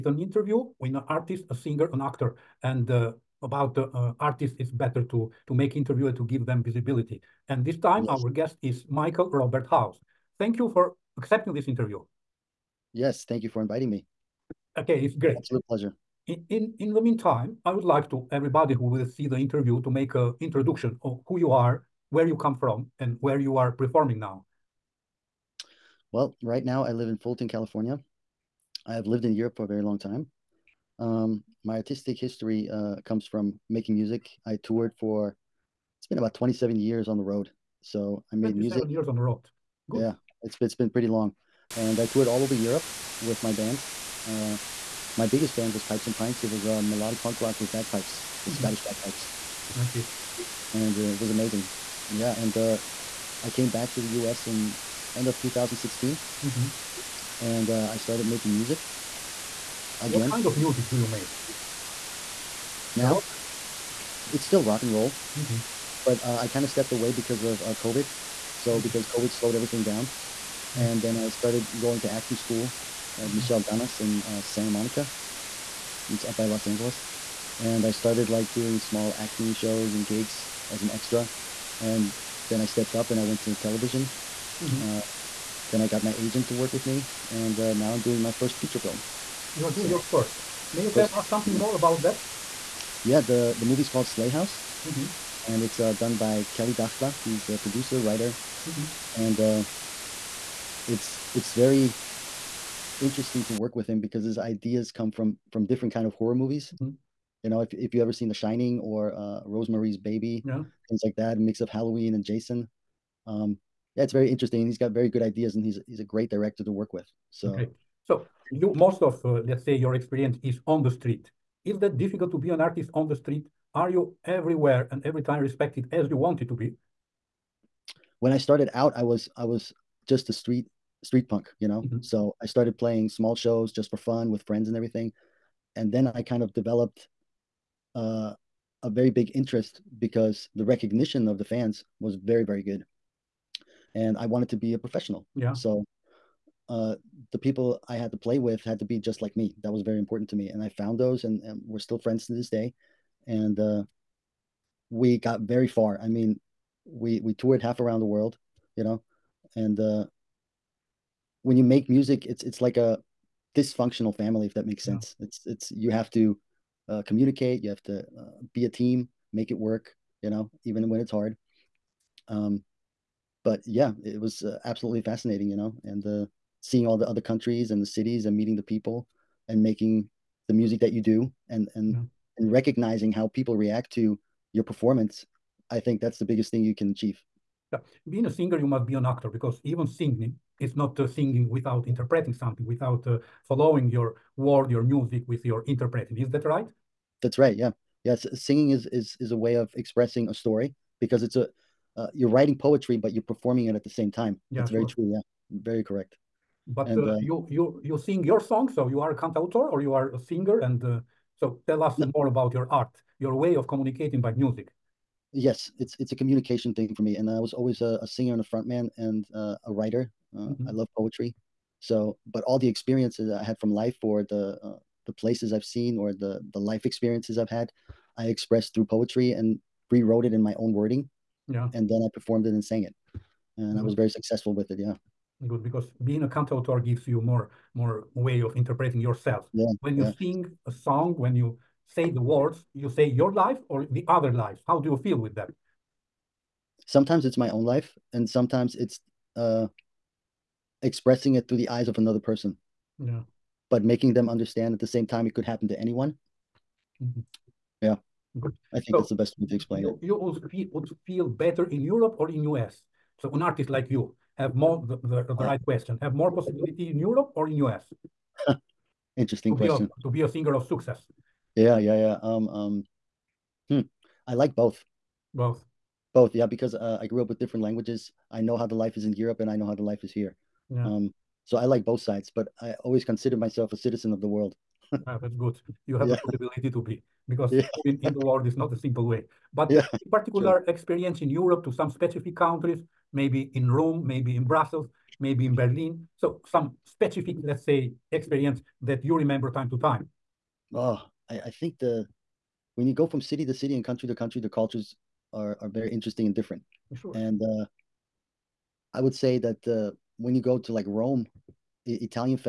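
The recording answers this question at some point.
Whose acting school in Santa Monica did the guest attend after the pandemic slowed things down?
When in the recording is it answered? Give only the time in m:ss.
1:13.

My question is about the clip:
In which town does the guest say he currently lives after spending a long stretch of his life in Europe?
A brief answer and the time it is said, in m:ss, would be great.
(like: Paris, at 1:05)
Fulton, at 0:27.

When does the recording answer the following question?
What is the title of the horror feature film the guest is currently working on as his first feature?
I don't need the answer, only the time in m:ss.
1:34.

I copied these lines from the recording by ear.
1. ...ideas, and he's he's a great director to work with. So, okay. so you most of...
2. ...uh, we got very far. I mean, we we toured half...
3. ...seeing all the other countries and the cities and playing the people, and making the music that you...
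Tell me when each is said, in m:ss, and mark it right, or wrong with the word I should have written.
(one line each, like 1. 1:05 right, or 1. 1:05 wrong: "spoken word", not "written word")
1. 1:55 right
2. 2:33 right
3. 2:56 wrong: "meeting", not "playing".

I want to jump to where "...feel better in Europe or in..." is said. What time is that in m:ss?
4:21.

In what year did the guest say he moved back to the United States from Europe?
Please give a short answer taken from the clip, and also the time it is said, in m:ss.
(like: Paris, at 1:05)
2016, at 0:55.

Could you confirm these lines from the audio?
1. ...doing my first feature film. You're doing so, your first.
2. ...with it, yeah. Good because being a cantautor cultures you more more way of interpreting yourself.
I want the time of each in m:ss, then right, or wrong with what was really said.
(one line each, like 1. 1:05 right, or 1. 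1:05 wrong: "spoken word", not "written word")
1. 1:28 right
2. 3:54 wrong: "gives", not "cultures".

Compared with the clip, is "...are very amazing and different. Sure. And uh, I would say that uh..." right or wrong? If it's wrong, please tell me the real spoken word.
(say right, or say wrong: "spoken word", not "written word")
wrong: "interesting", not "amazing".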